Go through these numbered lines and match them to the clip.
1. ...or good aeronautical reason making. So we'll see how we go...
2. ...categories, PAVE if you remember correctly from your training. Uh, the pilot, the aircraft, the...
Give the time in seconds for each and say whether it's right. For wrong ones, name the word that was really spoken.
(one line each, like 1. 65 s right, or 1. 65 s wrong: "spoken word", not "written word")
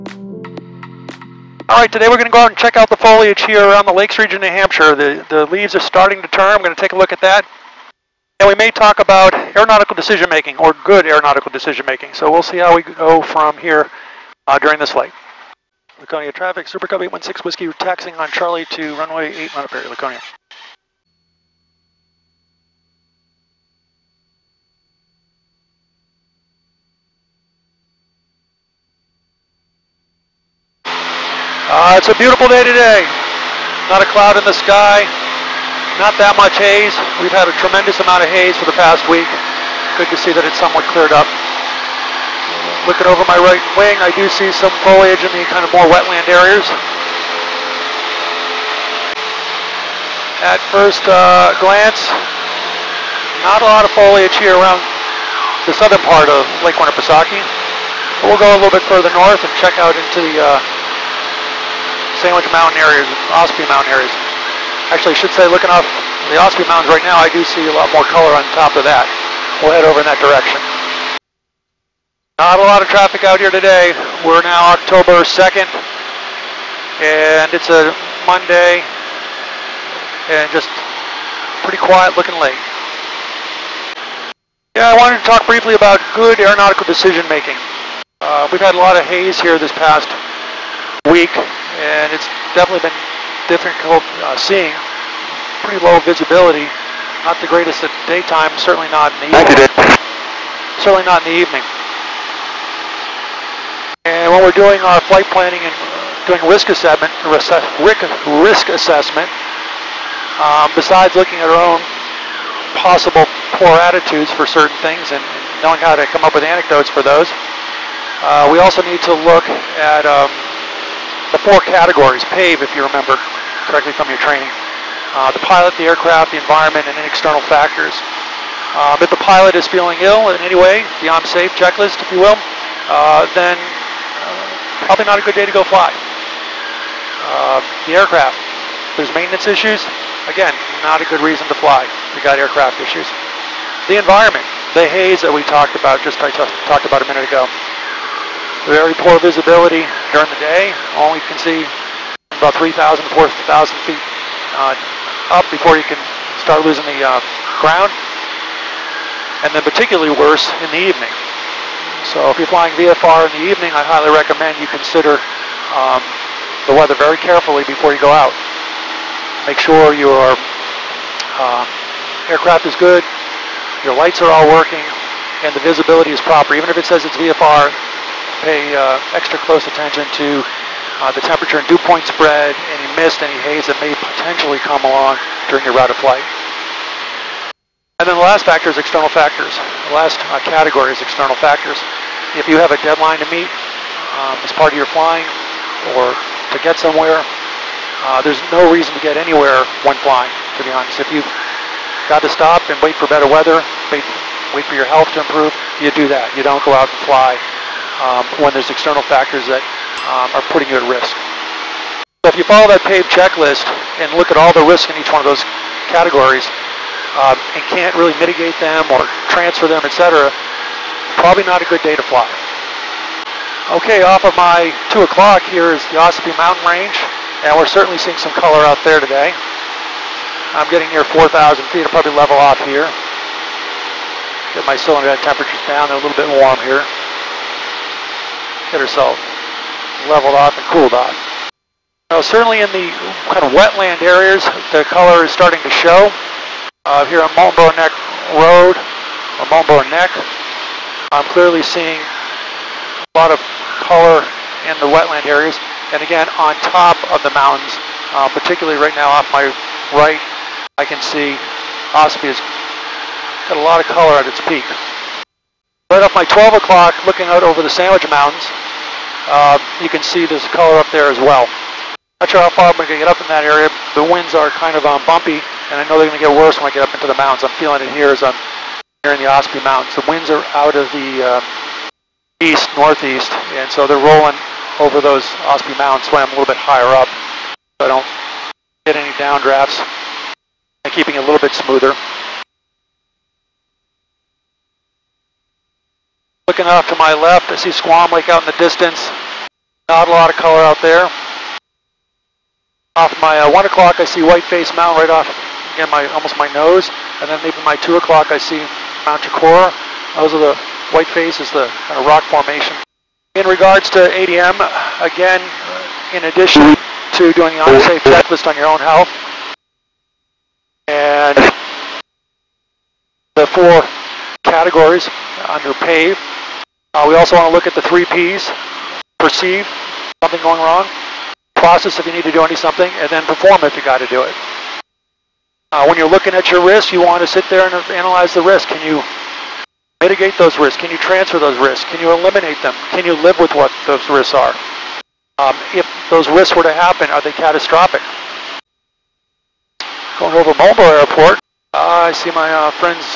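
1. 10 s wrong: "decision", not "reason"
2. 121 s right.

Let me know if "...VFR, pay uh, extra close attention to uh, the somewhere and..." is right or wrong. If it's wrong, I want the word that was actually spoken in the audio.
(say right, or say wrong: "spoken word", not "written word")
wrong: "temperature", not "somewhere".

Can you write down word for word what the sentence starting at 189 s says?
The last uh, category is external factors.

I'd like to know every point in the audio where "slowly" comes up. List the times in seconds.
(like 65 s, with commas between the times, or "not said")
not said.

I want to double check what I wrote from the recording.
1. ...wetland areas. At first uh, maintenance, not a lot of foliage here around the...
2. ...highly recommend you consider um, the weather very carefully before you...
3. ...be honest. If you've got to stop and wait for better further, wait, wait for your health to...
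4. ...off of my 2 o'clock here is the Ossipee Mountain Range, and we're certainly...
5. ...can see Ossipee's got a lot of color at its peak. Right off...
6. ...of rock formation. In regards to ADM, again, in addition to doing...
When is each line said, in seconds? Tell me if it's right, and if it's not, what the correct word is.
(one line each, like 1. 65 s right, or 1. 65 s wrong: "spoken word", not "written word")
1. 45 s wrong: "glance", not "maintenance"
2. 163 s right
3. 200 s wrong: "weather", not "further"
4. 224 s right
5. 260 s right
6. 311 s right.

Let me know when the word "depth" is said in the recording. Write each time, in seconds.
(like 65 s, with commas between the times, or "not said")
not said.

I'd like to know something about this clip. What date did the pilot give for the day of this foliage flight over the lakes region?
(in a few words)
October 2.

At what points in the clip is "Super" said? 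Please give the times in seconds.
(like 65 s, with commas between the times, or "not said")
16 s.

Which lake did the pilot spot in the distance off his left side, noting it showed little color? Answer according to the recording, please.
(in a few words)
Squam Lake.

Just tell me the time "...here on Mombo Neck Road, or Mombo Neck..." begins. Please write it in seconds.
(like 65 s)
247 s.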